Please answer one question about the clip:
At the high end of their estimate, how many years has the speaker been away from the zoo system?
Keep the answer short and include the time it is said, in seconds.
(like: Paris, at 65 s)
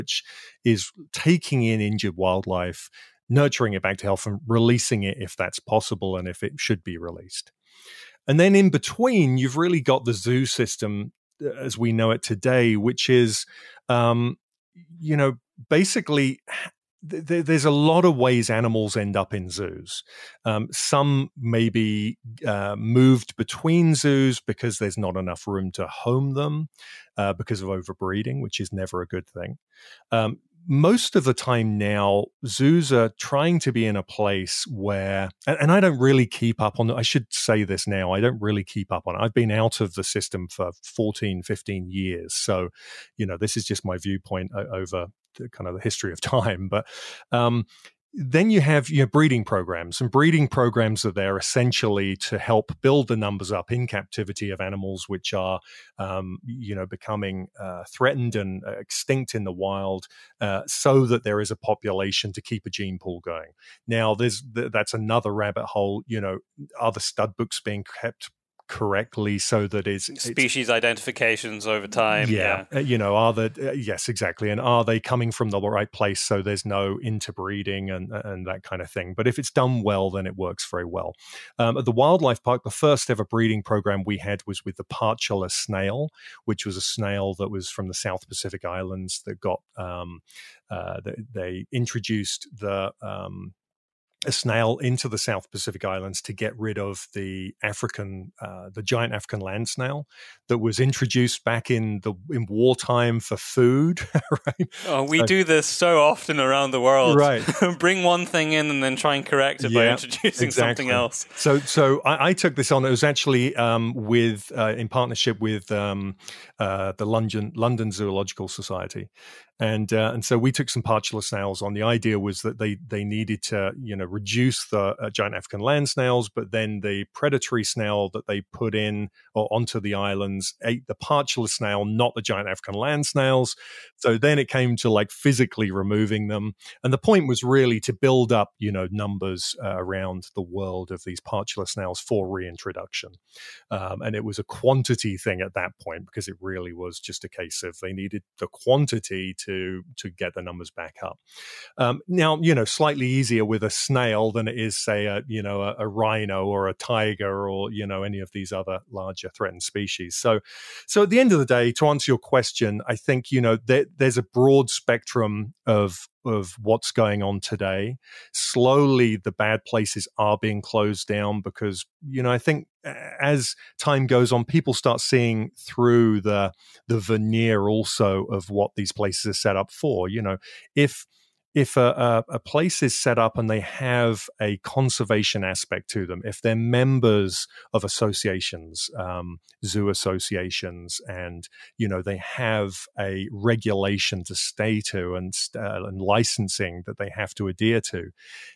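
15, at 41 s.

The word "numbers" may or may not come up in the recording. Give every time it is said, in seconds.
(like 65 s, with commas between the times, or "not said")
53 s, 138 s, 150 s.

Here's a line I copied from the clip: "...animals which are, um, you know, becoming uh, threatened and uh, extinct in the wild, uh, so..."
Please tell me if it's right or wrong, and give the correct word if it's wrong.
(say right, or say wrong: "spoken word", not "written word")
right.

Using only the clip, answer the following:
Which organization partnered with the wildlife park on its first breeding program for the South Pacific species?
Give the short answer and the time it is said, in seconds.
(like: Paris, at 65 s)
London Zoological Society, at 117 s.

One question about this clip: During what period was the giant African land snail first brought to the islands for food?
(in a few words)
wartime.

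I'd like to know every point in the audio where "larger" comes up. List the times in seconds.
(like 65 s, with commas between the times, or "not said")
158 s.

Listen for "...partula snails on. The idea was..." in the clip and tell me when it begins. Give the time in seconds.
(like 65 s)
120 s.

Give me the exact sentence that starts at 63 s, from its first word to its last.
Now, there's th that's another rabbit hole.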